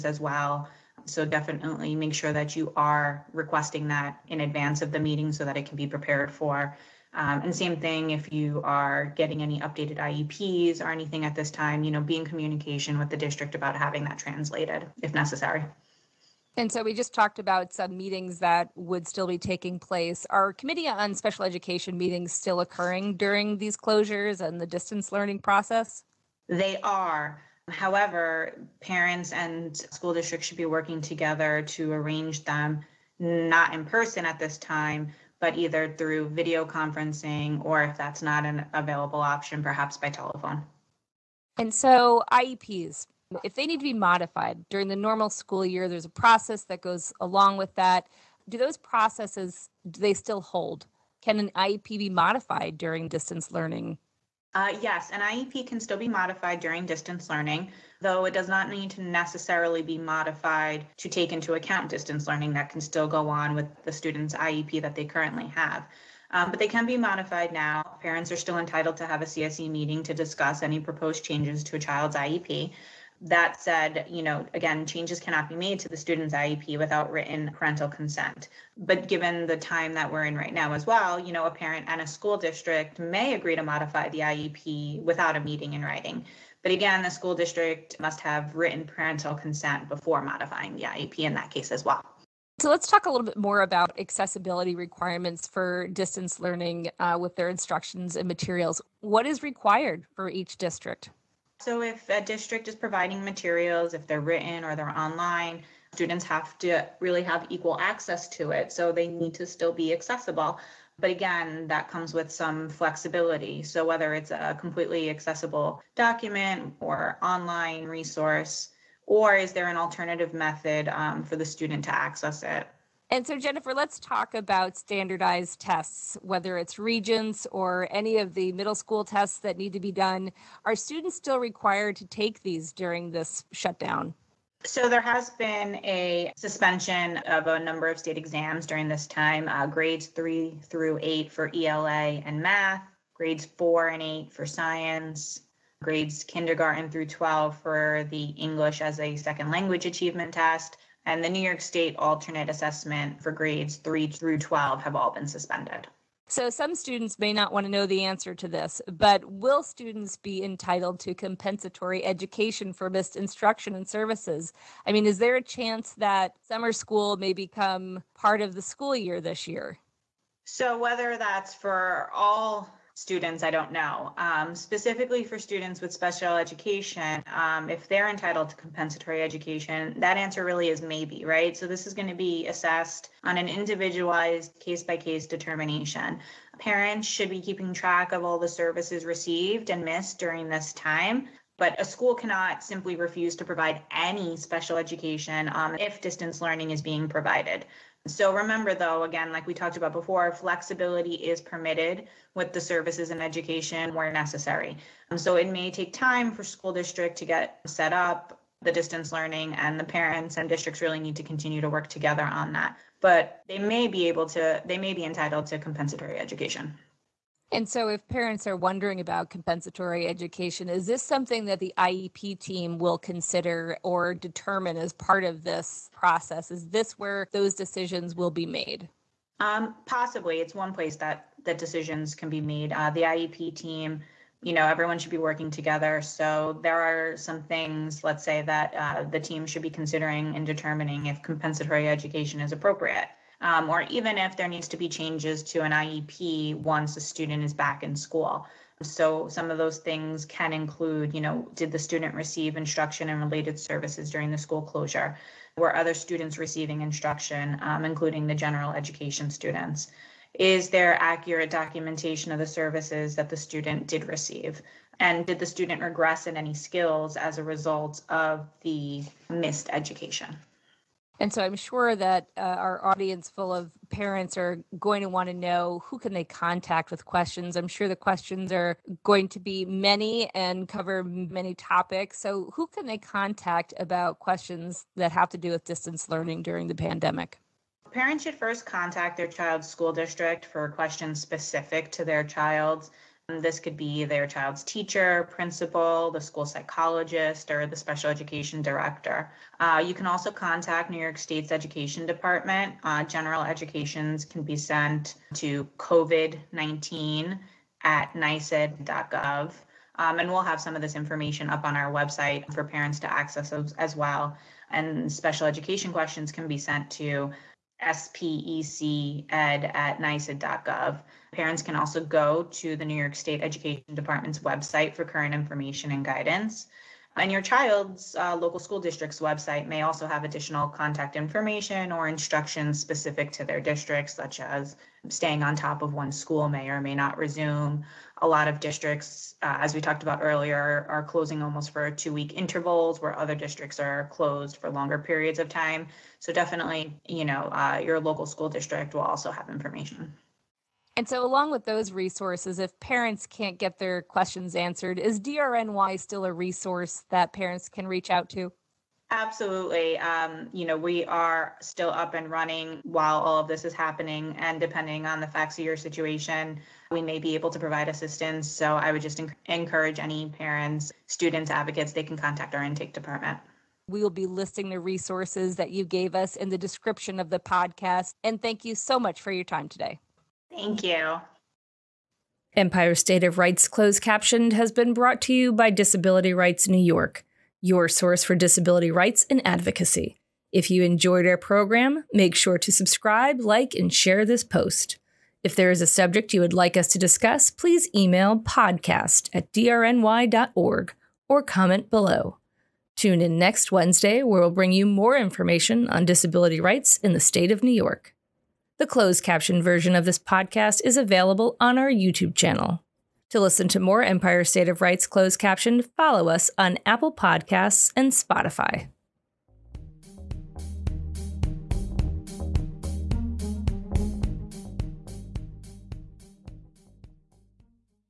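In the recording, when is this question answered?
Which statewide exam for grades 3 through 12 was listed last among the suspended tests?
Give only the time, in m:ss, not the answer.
2:31.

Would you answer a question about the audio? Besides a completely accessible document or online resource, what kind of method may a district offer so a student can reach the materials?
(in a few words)
Alternative method.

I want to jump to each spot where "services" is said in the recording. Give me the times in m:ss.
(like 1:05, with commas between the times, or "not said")
2:43, 3:08, 3:22, 4:13, 4:22.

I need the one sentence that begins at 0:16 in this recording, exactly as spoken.
And so we just talked about some meetings that would still be taking place.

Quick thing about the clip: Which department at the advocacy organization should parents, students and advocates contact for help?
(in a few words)
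Intake department.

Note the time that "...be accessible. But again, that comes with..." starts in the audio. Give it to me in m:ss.
1:49.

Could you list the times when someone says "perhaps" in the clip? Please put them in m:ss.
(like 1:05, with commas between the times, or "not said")
0:39.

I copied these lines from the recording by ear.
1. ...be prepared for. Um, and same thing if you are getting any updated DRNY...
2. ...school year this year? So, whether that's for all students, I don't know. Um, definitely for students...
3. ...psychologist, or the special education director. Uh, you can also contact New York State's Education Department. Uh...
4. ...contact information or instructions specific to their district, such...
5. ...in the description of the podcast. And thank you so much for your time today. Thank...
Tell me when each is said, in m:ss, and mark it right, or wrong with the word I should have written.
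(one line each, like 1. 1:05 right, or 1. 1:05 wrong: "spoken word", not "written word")
1. 0:05 wrong: "IEPs", not "DRNY"
2. 2:48 wrong: "specifically", not "definitely"
3. 4:56 right
4. 5:30 right
5. 6:16 right.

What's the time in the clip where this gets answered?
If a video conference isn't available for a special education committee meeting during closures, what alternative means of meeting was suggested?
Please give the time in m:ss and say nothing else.
0:39.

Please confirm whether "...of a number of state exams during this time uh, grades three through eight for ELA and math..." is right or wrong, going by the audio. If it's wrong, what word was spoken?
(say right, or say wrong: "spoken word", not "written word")
right.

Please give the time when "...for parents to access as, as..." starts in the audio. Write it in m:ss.
5:12.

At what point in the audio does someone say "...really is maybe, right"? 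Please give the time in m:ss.
3:00.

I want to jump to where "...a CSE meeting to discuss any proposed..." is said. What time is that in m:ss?
1:09.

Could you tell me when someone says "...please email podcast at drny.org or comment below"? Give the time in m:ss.
6:37.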